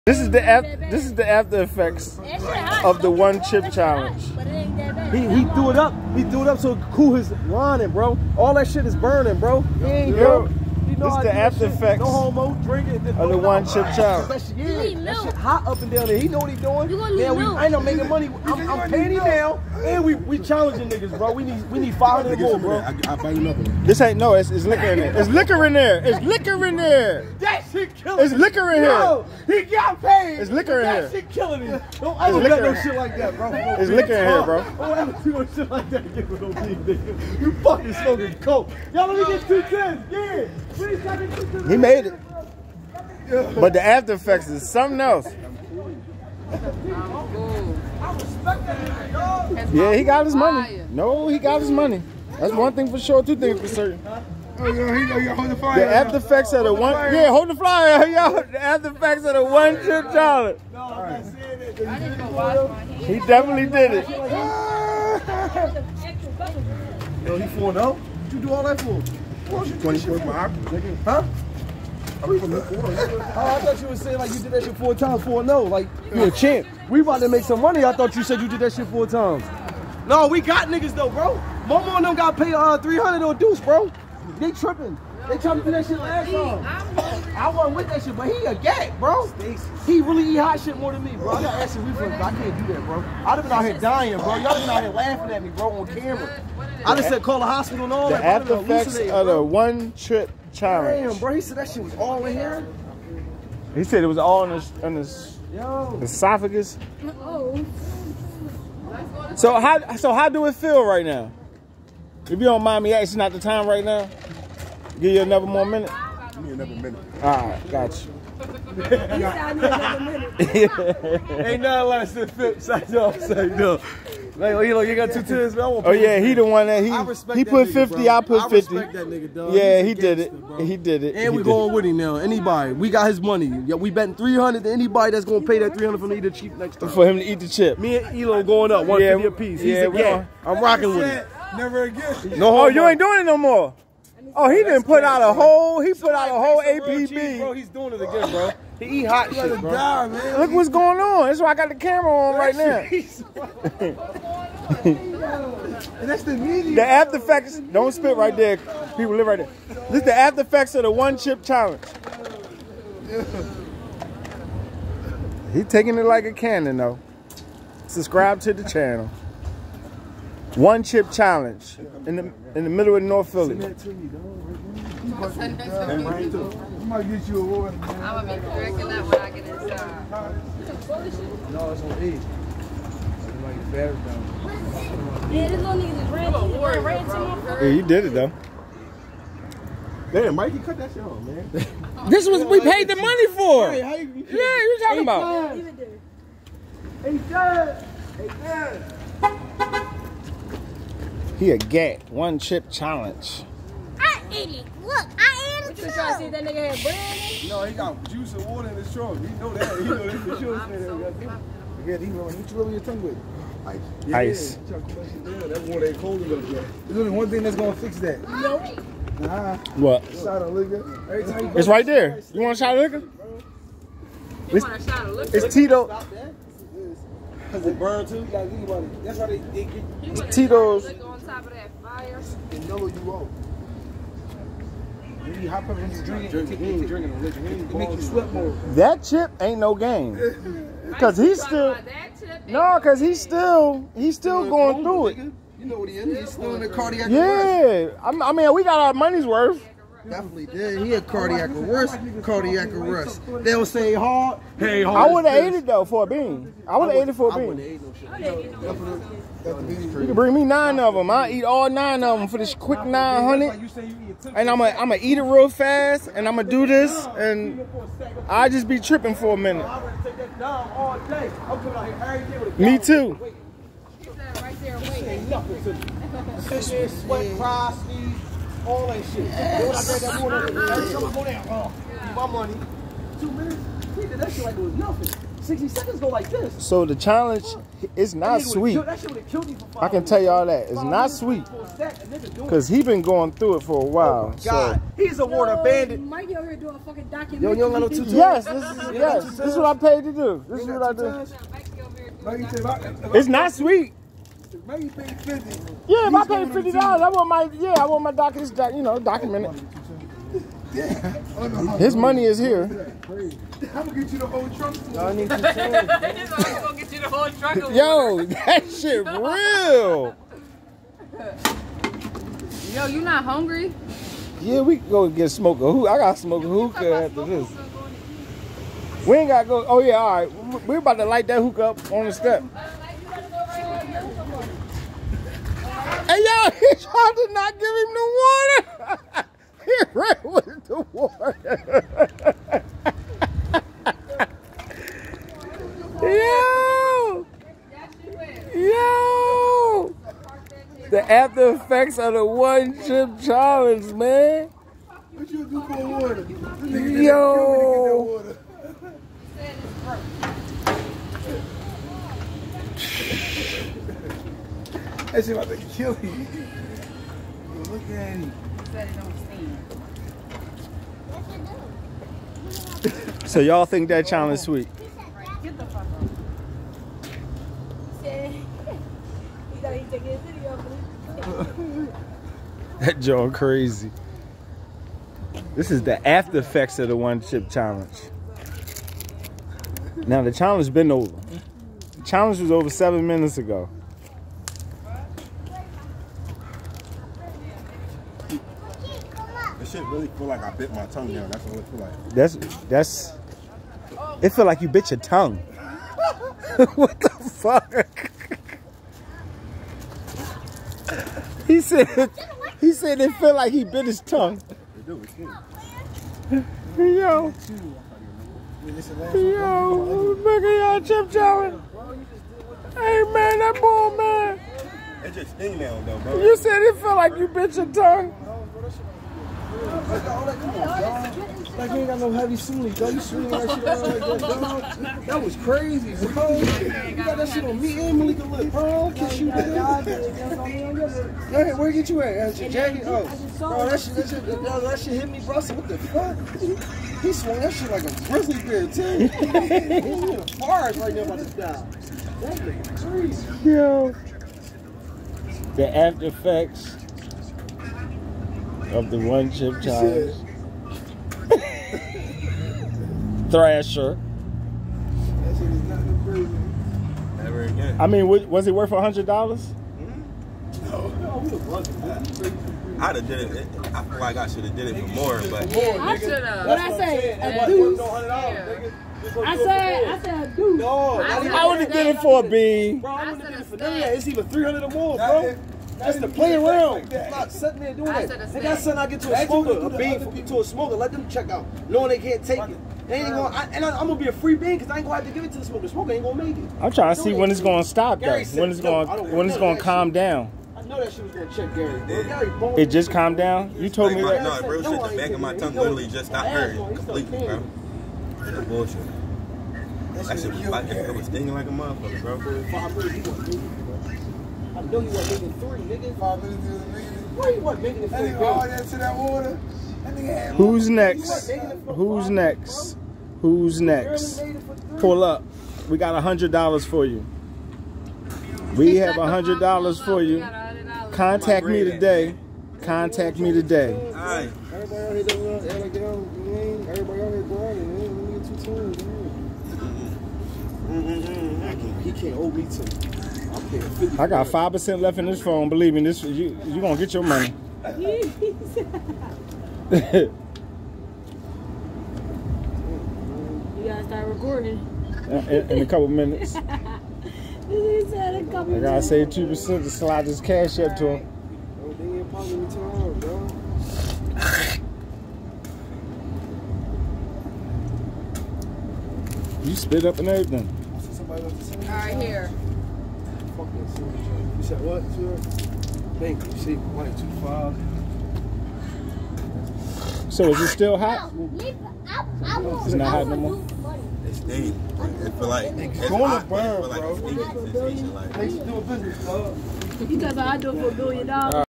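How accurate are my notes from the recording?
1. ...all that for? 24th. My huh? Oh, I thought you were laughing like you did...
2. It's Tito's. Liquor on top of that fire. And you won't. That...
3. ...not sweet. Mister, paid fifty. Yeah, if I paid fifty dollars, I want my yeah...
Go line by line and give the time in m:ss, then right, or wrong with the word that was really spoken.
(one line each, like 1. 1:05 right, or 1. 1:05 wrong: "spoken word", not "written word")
1. 1:08 wrong: "saying", not "laughing"
2. 3:50 right
3. 5:03 right.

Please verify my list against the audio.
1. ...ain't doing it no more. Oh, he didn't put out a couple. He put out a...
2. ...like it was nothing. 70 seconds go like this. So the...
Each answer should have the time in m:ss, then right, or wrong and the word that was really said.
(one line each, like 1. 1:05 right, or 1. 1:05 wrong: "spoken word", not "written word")
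1. 2:22 wrong: "whole", not "couple"
2. 4:44 wrong: "60", not "70".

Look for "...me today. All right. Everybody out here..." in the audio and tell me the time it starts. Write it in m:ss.
8:53.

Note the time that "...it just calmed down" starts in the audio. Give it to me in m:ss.
8:22.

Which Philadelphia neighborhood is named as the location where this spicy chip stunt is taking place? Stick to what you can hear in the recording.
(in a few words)
North Philly.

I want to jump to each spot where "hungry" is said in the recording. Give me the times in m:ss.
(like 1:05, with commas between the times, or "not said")
5:23.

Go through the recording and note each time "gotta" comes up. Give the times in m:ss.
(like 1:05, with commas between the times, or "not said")
3:48, 5:29, 9:13, 9:18.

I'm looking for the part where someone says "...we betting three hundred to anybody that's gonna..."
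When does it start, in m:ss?
2:13.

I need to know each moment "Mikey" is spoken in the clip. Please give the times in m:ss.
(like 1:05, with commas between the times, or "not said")
3:10, 4:55.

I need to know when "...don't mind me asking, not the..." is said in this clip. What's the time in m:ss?
1:52.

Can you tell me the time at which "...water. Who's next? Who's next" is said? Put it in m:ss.
8:38.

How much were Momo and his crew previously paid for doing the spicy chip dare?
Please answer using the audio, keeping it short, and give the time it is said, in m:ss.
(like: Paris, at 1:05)
300, at 1:22.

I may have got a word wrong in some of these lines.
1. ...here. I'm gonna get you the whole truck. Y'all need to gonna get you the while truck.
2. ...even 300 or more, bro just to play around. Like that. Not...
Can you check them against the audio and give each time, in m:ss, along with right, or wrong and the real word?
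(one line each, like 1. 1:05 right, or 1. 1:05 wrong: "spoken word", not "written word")
1. 5:12 wrong: "whole", not "while"
2. 8:04 right.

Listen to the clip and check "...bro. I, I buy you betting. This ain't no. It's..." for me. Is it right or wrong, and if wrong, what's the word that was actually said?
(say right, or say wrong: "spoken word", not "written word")
wrong: "nothing", not "betting".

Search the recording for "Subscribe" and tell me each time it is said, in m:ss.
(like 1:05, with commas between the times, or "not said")
2:47.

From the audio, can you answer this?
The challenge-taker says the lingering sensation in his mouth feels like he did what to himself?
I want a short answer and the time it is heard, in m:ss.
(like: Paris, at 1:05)
Bit his tongue, at 6:40.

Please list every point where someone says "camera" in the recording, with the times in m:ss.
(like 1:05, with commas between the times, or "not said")
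1:35, 2:31.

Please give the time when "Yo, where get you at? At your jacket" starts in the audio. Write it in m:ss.
7:21.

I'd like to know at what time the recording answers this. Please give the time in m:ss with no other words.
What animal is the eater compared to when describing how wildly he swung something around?
7:28.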